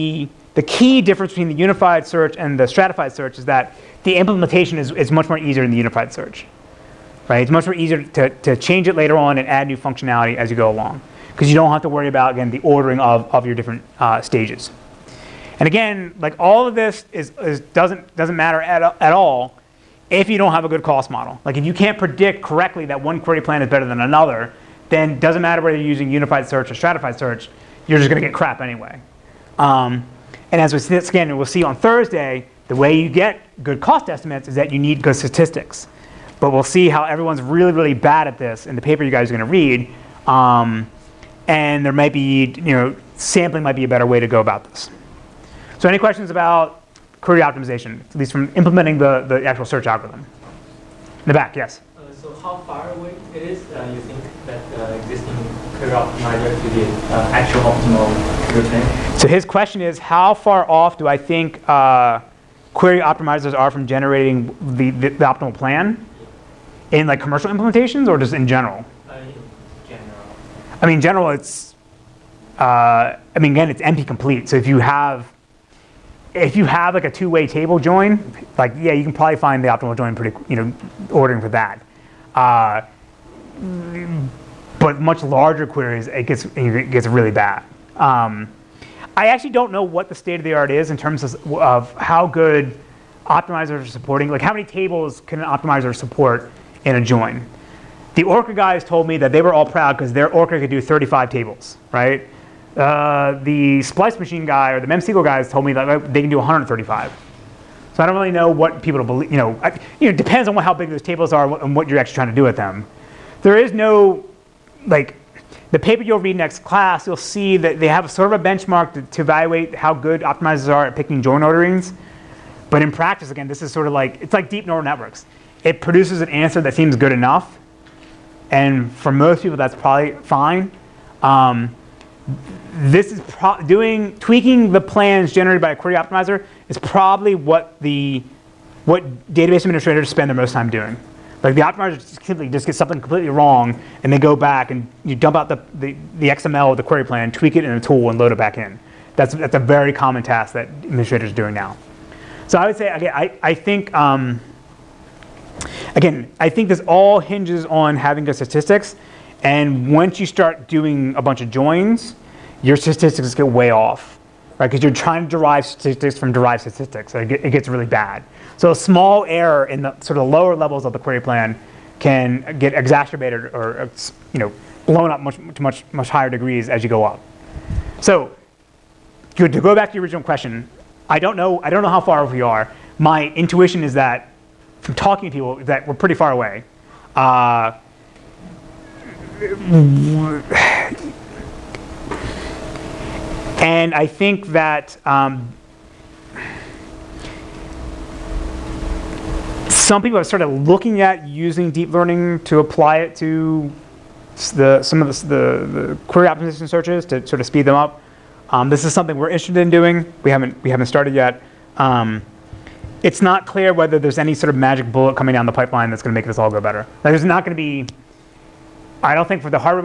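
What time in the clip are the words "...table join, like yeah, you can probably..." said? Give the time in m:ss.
1:17.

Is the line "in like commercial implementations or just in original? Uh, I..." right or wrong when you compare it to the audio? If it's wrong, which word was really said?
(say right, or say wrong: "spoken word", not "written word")
wrong: "general", not "original".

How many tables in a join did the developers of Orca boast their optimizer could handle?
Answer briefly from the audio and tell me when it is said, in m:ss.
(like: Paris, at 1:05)
35, at 1:40.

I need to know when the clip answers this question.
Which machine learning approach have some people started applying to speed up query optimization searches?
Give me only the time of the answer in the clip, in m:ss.
3:21.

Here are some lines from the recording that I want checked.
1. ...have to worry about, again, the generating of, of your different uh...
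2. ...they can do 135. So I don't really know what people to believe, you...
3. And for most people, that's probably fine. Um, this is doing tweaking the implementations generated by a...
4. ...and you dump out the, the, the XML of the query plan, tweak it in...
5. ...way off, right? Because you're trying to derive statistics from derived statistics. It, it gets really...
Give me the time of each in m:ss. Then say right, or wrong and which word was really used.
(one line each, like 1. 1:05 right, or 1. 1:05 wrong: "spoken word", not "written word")
1. 0:11 wrong: "ordering", not "generating"
2. 1:46 right
3. 2:08 wrong: "plans", not "implementations"
4. 2:24 right
5. 2:43 right.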